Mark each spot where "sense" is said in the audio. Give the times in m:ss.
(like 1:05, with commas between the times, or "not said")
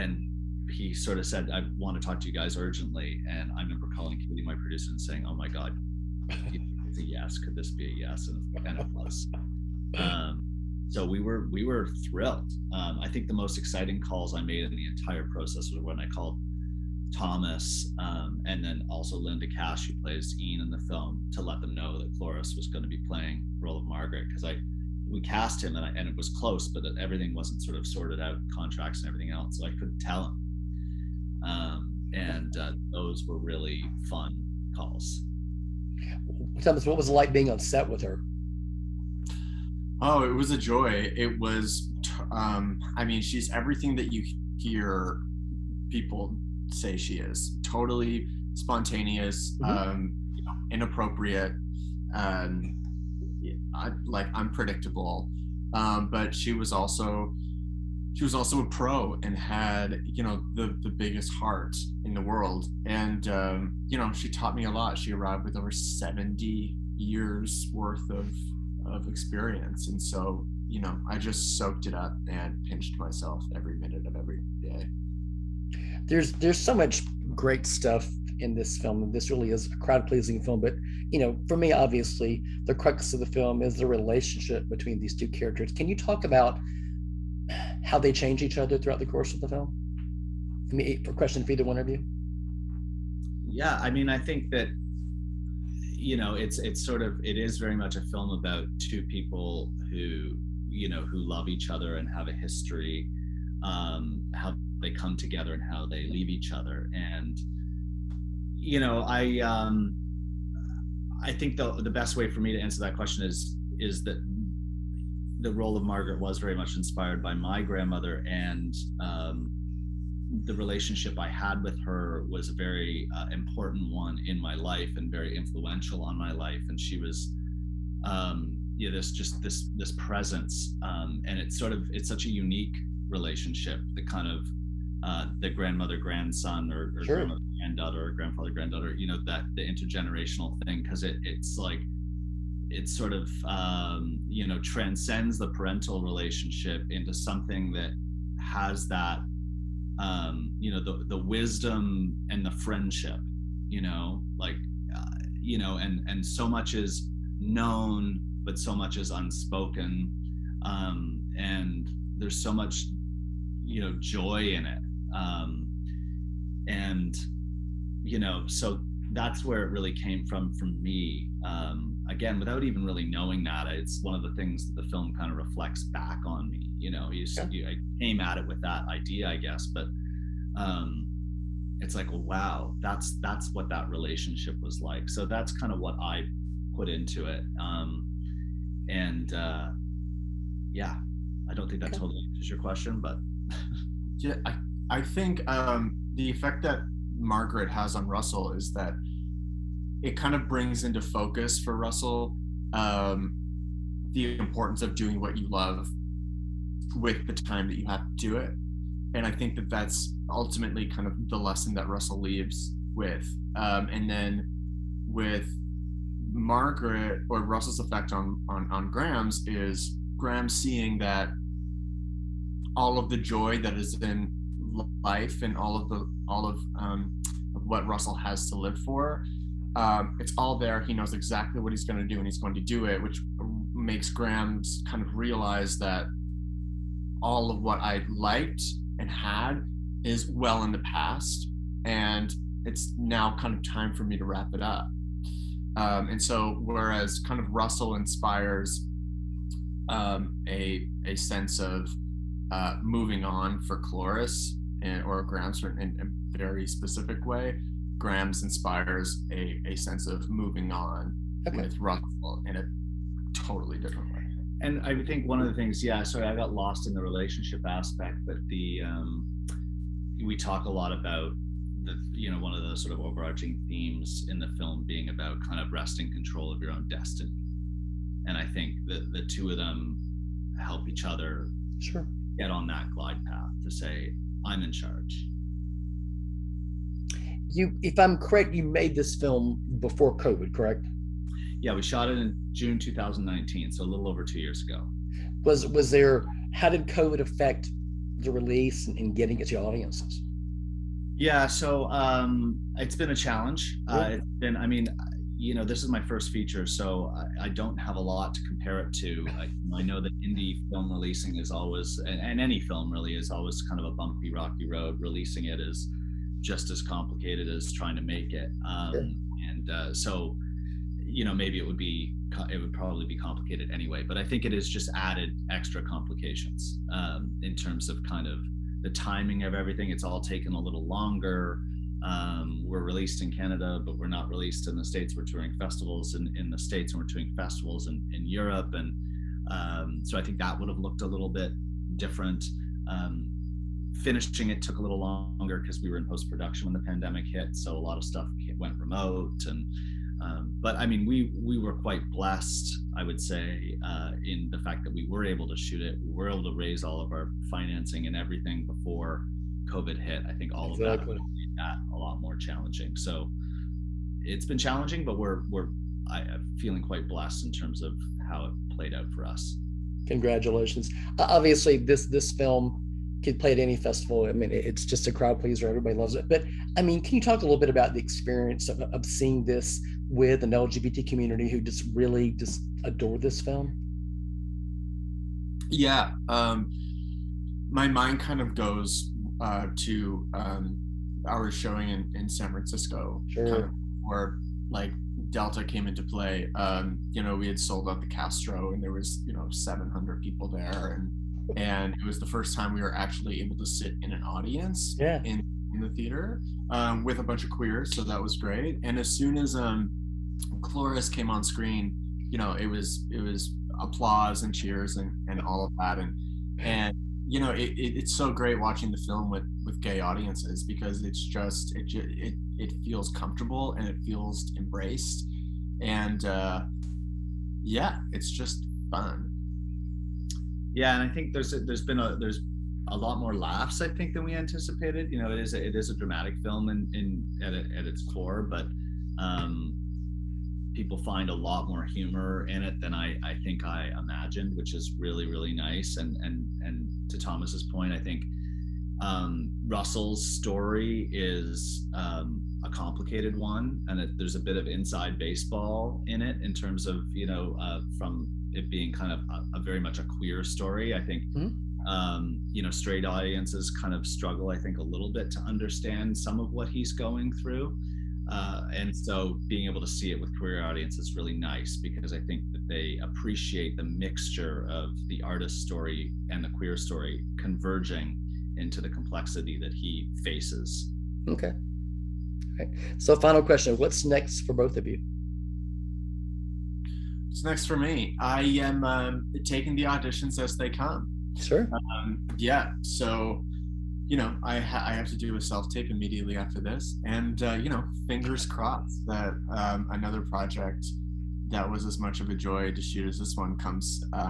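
4:11, 4:19.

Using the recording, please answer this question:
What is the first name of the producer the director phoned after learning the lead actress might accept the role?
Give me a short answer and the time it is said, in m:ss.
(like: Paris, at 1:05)
Katie, at 0:04.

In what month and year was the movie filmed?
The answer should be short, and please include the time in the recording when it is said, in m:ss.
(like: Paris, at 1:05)
June 2019, at 4:52.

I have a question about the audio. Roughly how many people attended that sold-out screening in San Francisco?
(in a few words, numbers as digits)
700.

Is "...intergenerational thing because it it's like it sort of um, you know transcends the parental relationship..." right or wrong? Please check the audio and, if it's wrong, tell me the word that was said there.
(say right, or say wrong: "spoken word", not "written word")
right.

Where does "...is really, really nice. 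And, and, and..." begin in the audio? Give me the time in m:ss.
7:24.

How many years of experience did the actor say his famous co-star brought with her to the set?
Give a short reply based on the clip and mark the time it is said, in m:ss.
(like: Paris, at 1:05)
Over 70 years, at 1:05.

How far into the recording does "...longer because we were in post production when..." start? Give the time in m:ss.
5:44.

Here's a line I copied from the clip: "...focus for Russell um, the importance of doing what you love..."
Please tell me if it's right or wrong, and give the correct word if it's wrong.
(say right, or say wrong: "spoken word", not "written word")
right.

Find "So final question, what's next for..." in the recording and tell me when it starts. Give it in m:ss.
8:02.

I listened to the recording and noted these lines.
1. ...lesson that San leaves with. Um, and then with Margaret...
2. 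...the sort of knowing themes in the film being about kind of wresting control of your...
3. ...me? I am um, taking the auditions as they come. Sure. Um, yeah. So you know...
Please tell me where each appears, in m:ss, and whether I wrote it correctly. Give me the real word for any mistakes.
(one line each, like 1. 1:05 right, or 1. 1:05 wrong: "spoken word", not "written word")
1. 3:31 wrong: "Russell", not "San"
2. 4:32 wrong: "overarching", not "knowing"
3. 8:07 right.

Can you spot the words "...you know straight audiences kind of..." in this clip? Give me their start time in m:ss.
7:42.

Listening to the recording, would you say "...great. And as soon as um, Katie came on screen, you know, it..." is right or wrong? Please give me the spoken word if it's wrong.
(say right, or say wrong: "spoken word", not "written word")
wrong: "Cloris", not "Katie".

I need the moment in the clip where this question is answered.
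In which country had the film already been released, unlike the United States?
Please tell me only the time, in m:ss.
5:33.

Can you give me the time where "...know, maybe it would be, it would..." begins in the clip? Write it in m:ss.
5:21.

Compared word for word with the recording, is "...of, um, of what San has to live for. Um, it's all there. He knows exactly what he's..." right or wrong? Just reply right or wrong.
wrong.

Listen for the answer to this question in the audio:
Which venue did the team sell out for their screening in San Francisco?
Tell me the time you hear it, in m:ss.
6:37.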